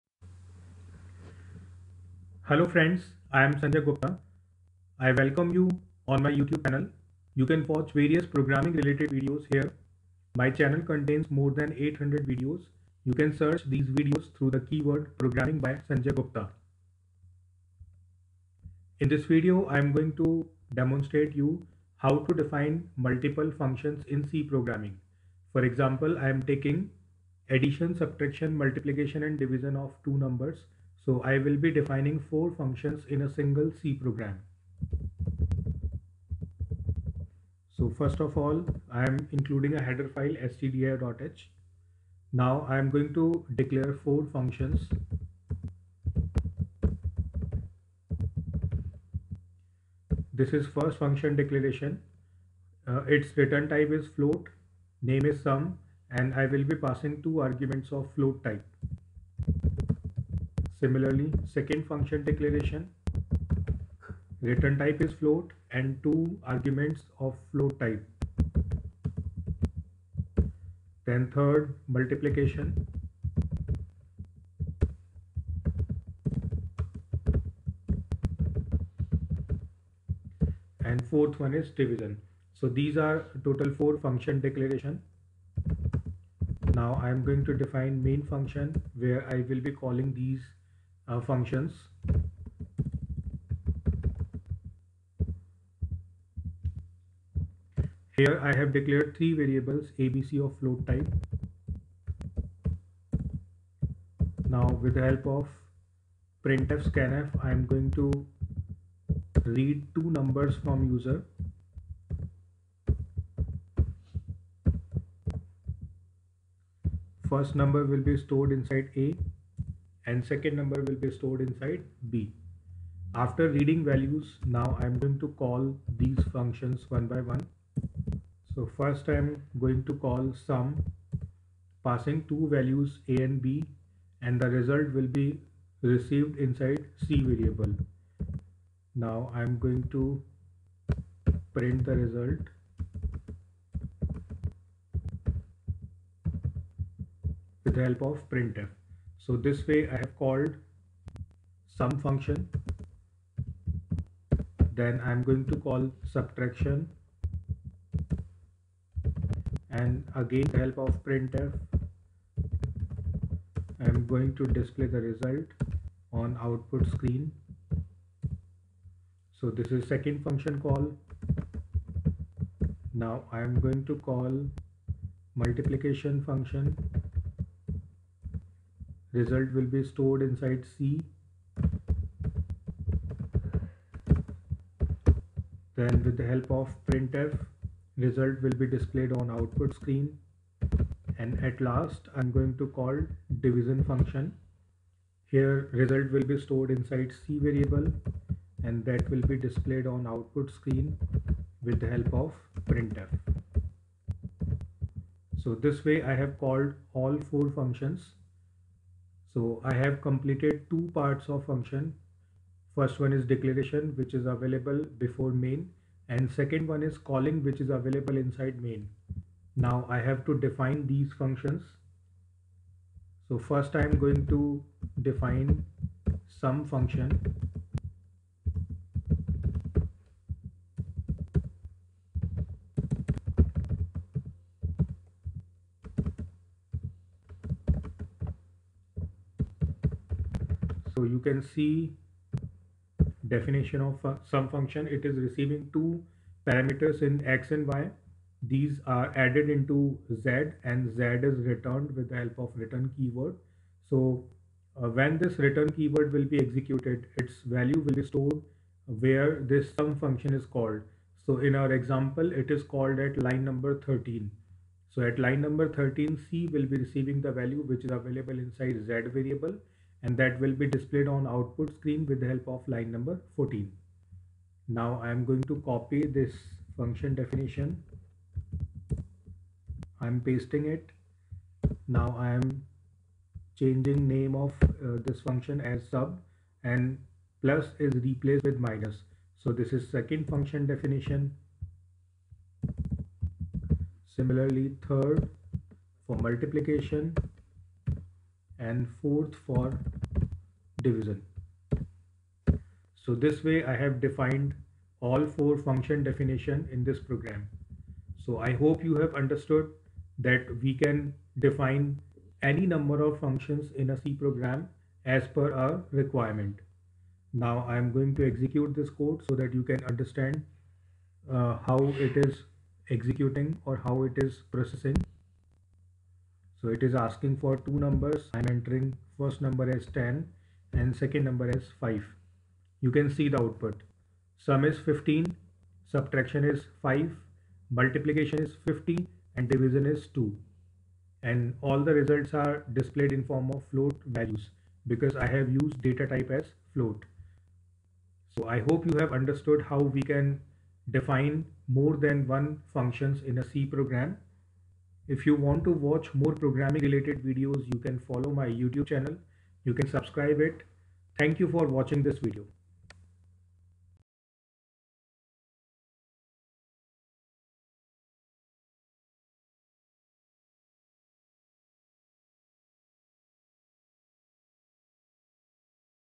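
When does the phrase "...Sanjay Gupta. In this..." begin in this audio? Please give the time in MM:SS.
00:15.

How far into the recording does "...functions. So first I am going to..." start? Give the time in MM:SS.
03:41.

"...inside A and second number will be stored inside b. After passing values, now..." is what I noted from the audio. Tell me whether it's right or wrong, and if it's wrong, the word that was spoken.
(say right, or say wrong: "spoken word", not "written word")
wrong: "reading", not "passing".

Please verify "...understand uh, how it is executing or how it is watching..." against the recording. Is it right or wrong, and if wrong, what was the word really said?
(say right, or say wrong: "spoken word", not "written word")
wrong: "processing", not "watching".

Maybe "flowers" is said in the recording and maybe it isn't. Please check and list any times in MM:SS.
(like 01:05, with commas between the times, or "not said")
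not said.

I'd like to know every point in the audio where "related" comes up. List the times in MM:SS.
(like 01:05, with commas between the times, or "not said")
00:08, 05:56.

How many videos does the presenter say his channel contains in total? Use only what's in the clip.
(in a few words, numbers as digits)
more than 800.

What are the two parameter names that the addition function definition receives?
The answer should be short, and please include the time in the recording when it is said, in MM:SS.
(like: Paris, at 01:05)
x and y, at 04:07.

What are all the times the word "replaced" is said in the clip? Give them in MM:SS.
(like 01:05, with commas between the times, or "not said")
04:48.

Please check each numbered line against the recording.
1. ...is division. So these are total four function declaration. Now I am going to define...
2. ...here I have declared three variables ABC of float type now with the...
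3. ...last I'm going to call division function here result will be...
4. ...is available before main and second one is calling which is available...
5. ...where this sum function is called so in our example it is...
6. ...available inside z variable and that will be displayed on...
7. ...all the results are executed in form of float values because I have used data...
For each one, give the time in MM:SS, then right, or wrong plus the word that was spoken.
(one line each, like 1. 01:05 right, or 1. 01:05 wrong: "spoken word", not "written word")
1. 01:21 right
2. 01:38 right
3. 03:11 right
4. 03:34 right
5. 04:19 right
6. 04:28 right
7. 05:41 wrong: "displayed", not "executed".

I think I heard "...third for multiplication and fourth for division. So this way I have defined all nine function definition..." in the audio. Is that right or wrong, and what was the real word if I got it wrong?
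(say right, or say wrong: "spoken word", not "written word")
wrong: "four", not "nine".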